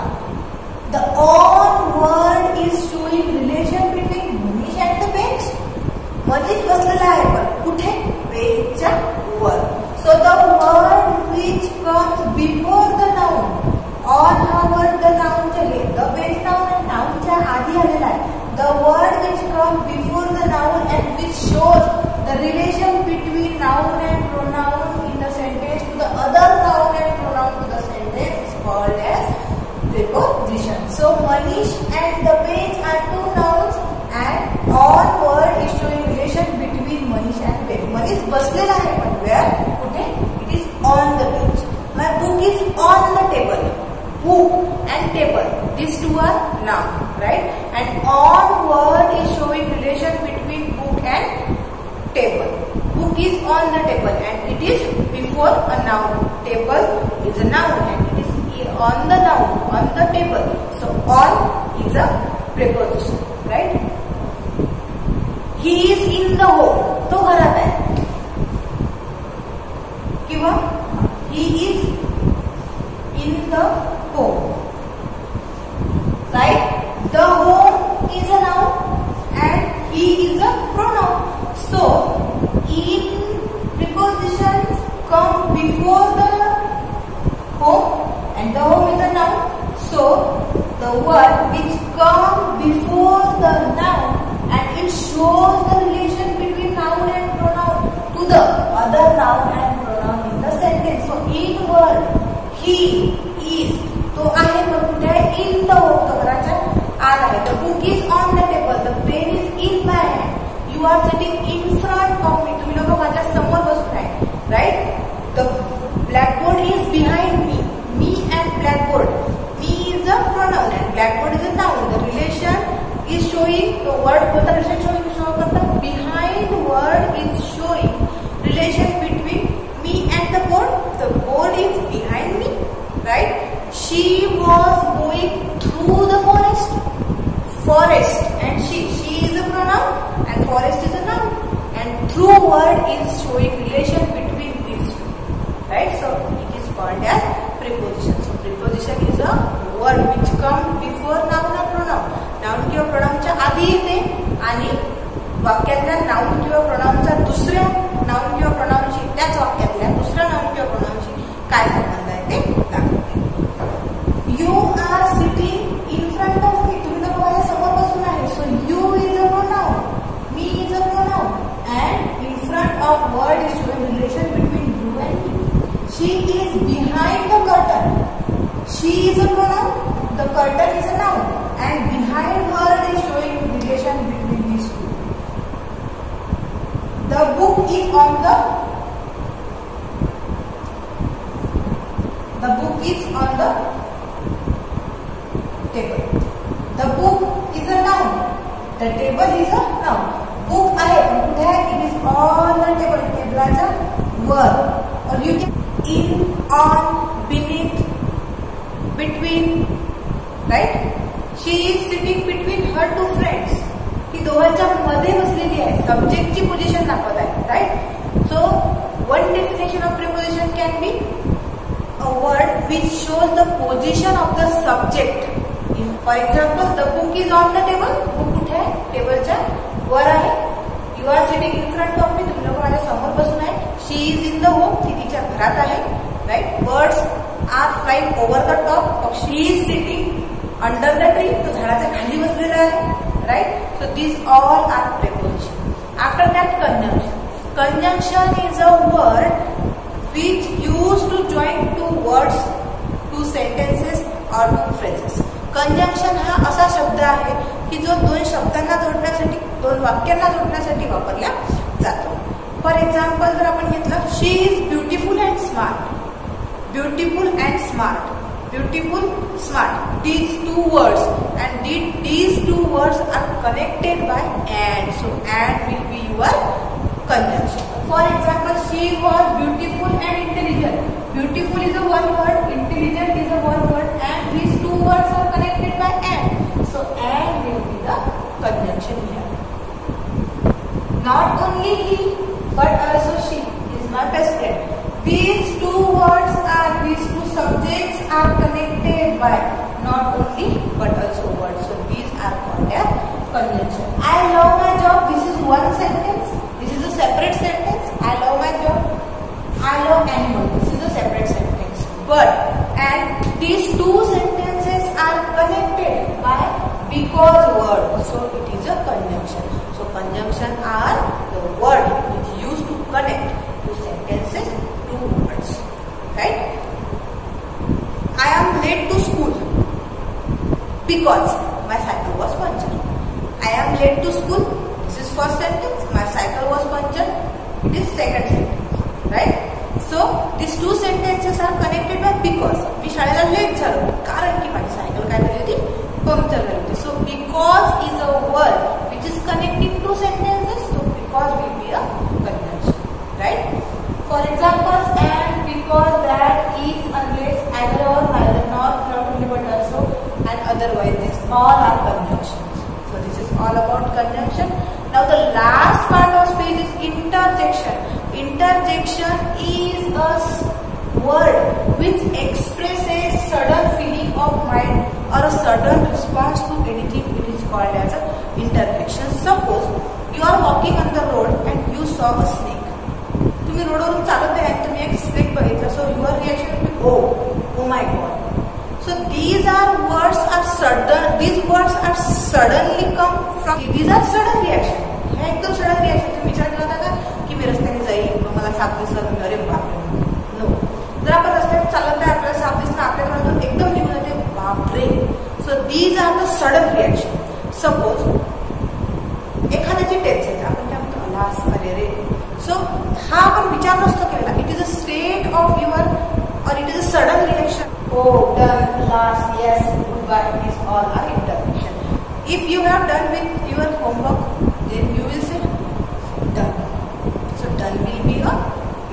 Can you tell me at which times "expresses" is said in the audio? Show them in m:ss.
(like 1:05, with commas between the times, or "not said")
6:12.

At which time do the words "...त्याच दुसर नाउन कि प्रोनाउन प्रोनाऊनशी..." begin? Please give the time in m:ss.
2:39.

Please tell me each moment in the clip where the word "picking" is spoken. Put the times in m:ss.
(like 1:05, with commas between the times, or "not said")
not said.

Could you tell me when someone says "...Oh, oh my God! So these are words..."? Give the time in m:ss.
6:26.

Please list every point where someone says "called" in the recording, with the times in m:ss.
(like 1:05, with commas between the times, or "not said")
2:26, 6:17.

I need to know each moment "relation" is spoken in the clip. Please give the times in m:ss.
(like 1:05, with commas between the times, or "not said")
1:35, 2:08, 2:23.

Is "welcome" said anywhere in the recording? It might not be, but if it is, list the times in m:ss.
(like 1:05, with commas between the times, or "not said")
not said.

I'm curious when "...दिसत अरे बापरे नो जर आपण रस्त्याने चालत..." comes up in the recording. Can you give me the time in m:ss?
6:38.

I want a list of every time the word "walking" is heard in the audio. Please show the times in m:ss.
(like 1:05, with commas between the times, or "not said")
6:20.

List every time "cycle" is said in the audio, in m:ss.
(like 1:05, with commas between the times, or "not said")
5:36, 5:44.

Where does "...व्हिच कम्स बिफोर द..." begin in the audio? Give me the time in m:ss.
0:11.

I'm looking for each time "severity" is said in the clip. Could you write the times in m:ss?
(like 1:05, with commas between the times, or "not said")
not said.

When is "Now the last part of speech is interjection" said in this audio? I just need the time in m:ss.
6:04.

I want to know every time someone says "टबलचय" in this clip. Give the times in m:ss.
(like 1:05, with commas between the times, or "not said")
3:23, 3:49.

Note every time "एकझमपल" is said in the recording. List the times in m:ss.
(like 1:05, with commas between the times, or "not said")
3:46, 4:22.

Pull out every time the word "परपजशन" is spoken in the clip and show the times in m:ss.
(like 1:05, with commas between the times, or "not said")
0:29, 3:39.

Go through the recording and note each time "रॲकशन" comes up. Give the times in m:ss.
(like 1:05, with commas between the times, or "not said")
6:35, 6:46, 6:57.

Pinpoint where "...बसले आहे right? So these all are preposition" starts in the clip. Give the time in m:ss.
4:02.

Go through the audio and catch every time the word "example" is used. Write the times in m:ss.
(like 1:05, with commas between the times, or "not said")
4:38, 5:54.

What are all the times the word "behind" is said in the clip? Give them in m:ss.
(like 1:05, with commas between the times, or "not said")
2:05, 2:11.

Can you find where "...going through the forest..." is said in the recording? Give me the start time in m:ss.
2:14.